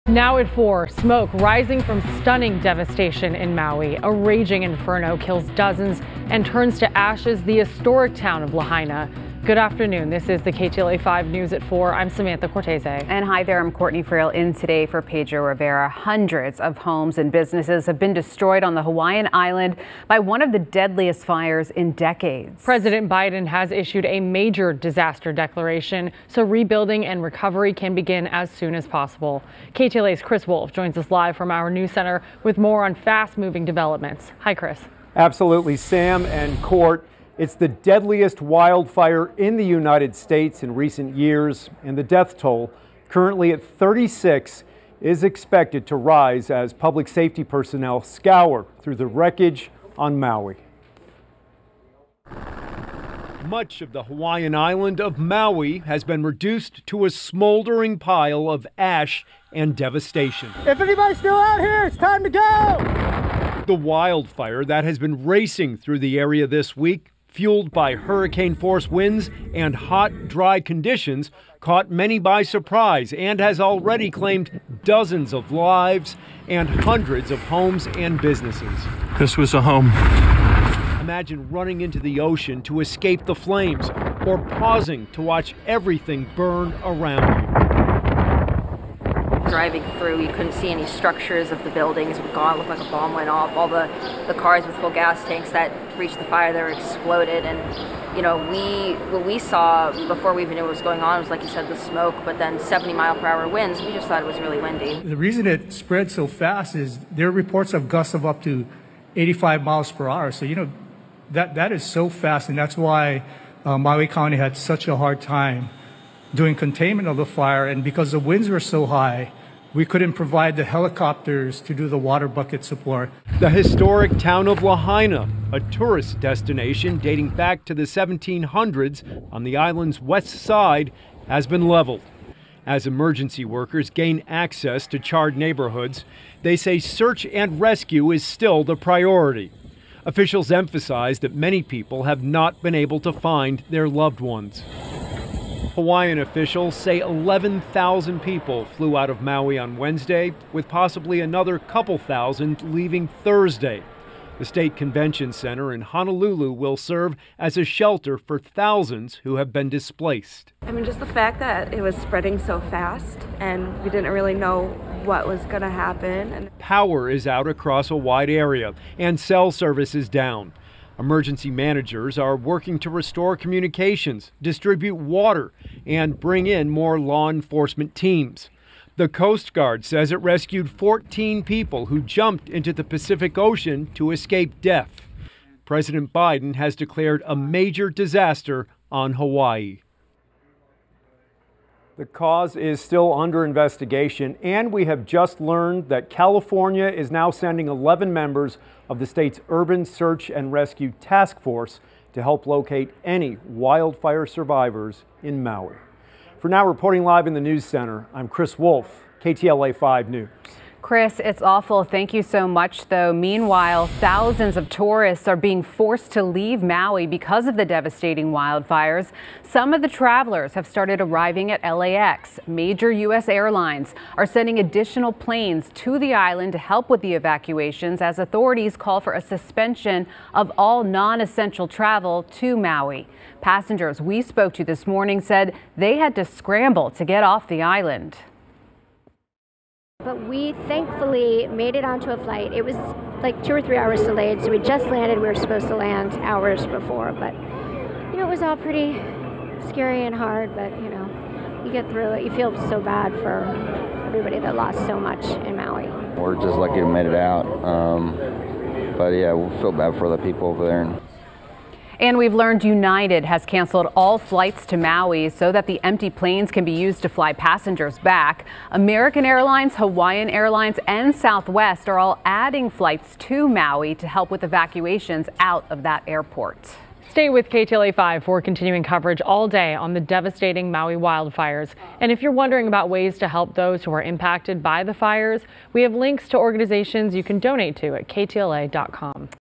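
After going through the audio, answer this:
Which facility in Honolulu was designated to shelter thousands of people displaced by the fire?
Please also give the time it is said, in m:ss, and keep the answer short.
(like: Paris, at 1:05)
State Convention Center, at 2:34.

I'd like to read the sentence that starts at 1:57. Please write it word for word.
And because the winds were so high, we couldn't provide the helicopters to do the water bucket support.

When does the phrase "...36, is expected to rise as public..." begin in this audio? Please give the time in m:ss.
0:43.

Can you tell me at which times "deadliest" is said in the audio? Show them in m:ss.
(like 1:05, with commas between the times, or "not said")
0:20, 0:37.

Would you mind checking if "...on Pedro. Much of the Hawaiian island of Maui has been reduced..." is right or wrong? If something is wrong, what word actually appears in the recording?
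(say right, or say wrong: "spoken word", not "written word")
wrong: "Maui", not "Pedro".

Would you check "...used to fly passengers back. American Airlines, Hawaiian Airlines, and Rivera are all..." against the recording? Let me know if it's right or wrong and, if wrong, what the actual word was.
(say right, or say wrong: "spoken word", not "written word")
wrong: "Southwest", not "Rivera".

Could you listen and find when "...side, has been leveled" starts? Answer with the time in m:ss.
2:10.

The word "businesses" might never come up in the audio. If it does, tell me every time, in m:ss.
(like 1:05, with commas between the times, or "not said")
0:17, 1:18.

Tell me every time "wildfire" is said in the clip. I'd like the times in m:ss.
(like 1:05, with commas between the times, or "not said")
0:38, 1:03, 3:23, 3:38, 4:40.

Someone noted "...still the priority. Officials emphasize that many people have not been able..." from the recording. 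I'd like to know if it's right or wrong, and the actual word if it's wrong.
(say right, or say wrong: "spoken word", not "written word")
right.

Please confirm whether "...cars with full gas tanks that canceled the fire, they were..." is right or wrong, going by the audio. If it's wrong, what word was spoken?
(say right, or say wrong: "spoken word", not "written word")
wrong: "reached", not "canceled".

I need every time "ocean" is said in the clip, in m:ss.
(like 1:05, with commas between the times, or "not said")
1:22, 3:03.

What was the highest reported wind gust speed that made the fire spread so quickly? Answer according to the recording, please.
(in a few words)
85 mph.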